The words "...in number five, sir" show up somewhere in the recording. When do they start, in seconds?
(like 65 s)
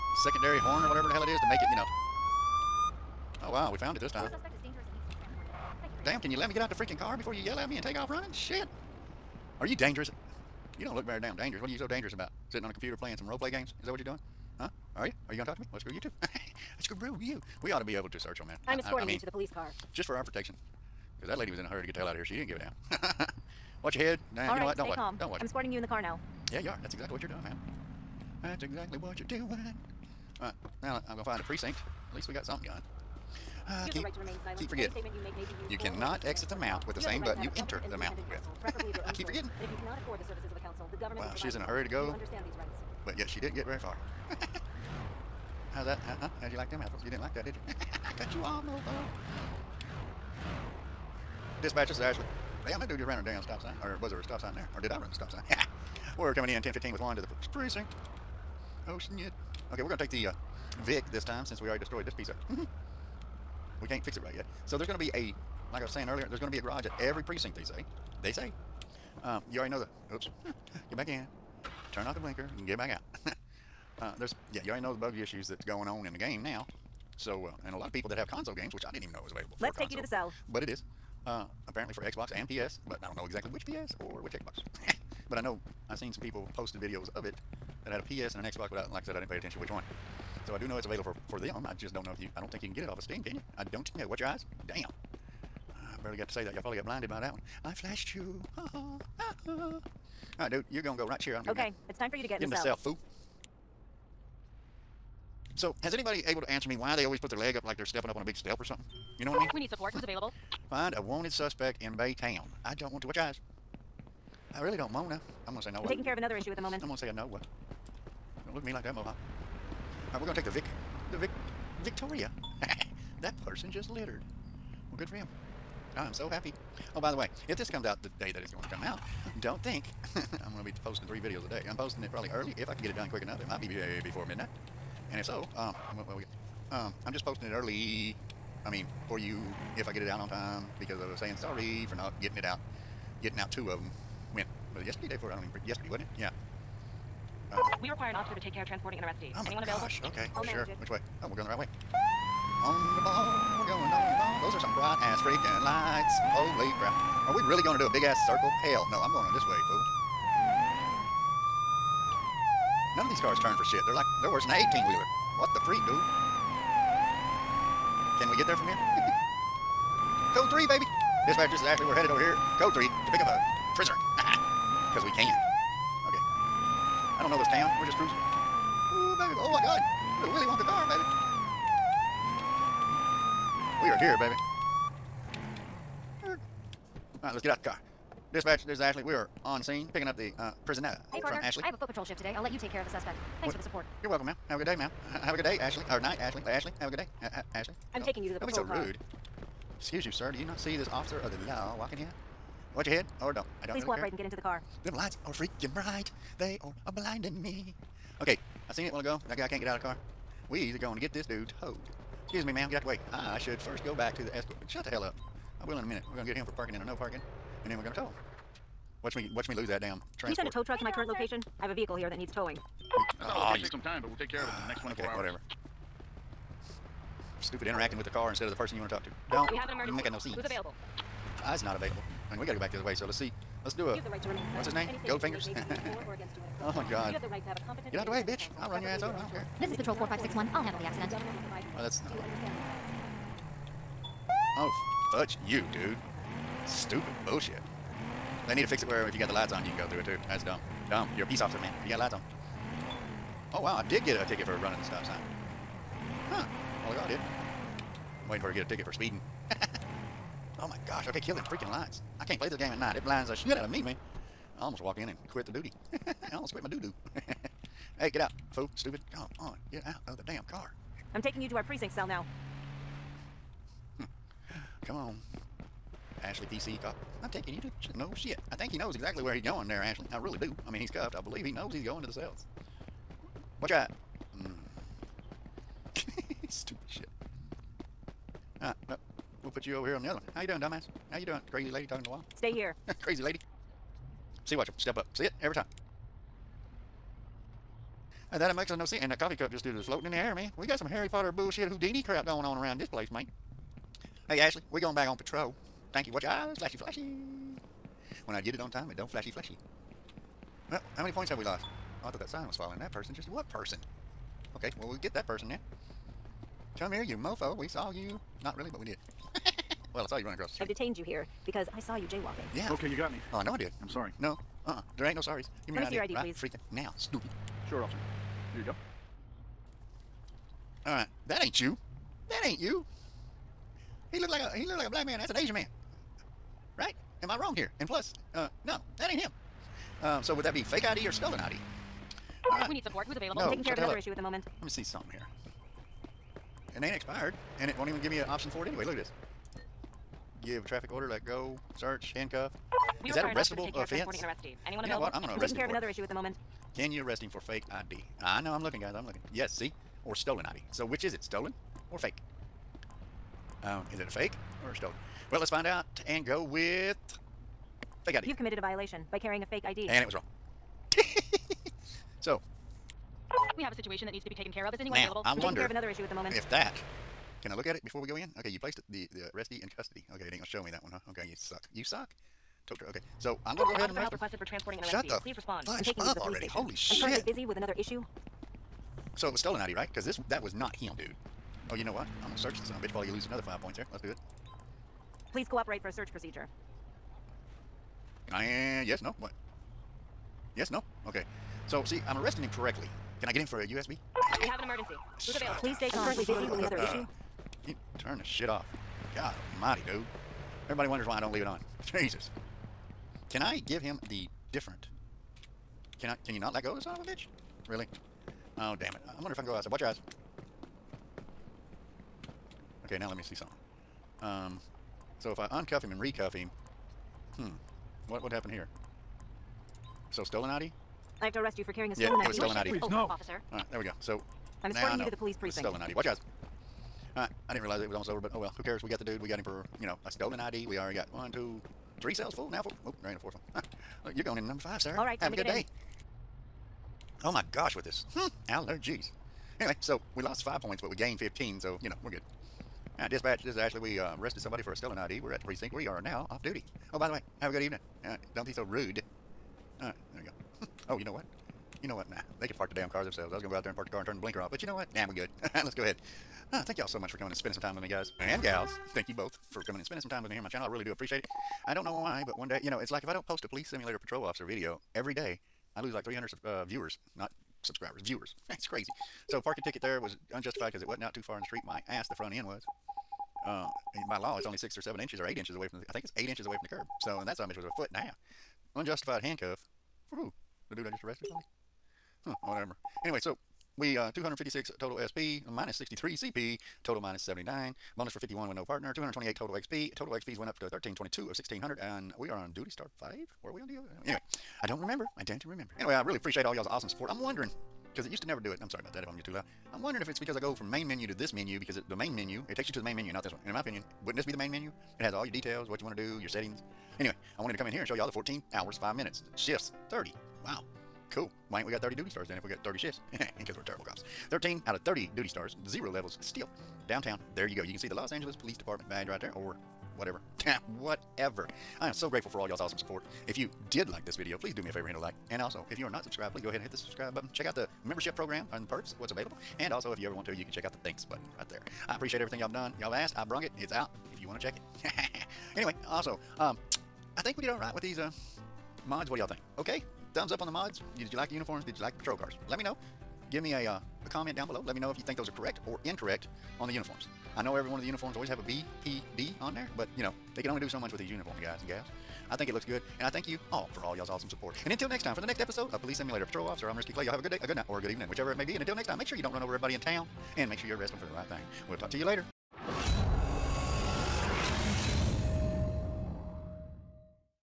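444 s.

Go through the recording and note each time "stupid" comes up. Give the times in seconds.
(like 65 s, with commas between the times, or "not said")
227 s, 246 s, 268 s, 286 s, 326 s.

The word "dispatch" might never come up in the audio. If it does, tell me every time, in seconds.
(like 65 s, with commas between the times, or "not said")
51 s, 171 s, 188 s, 453 s.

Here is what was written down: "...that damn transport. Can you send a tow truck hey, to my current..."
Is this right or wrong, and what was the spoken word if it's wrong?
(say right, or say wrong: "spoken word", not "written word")
right.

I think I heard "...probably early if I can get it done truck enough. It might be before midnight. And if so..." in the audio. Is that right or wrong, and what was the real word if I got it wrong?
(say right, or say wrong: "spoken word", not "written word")
wrong: "quick", not "truck".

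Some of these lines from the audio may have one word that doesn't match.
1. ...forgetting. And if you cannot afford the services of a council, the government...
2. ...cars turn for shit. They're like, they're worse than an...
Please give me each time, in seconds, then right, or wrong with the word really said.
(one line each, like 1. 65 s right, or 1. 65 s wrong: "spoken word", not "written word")
1. 39 s right
2. 163 s right.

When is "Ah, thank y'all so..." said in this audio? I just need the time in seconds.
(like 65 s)
466 s.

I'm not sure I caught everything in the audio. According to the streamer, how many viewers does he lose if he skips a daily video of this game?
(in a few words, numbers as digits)
300.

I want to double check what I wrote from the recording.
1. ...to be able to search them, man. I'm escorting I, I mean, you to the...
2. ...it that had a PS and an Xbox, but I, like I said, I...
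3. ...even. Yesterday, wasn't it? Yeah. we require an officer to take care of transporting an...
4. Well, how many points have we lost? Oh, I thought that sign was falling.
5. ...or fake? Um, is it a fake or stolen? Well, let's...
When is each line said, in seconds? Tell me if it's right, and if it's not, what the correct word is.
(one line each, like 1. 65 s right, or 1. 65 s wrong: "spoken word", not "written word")
1. 17 s right
2. 87 s right
3. 145 s right
4. 310 s right
5. 361 s right.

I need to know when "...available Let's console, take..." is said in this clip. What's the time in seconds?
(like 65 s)
79 s.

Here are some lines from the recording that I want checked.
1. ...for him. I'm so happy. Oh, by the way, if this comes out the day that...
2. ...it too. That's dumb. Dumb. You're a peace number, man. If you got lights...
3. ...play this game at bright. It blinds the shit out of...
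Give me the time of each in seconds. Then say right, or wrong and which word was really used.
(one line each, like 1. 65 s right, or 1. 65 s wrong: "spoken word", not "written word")
1. 125 s right
2. 249 s wrong: "officer", not "number"
3. 262 s wrong: "night", not "bright".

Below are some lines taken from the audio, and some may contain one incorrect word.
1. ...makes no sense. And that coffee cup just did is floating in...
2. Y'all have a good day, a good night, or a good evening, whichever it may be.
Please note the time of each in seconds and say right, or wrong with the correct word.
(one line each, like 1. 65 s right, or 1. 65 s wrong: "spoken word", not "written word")
1. 298 s right
2. 567 s right.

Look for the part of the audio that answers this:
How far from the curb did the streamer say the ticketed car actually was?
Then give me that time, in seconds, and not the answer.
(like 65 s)
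487 s.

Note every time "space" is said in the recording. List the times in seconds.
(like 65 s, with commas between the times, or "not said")
not said.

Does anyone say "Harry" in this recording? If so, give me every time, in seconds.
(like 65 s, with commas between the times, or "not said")
300 s.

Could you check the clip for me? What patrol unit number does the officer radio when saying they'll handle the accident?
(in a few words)
4561.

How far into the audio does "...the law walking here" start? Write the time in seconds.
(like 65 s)
201 s.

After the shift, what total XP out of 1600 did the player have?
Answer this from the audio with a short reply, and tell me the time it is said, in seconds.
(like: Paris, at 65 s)
1322, at 500 s.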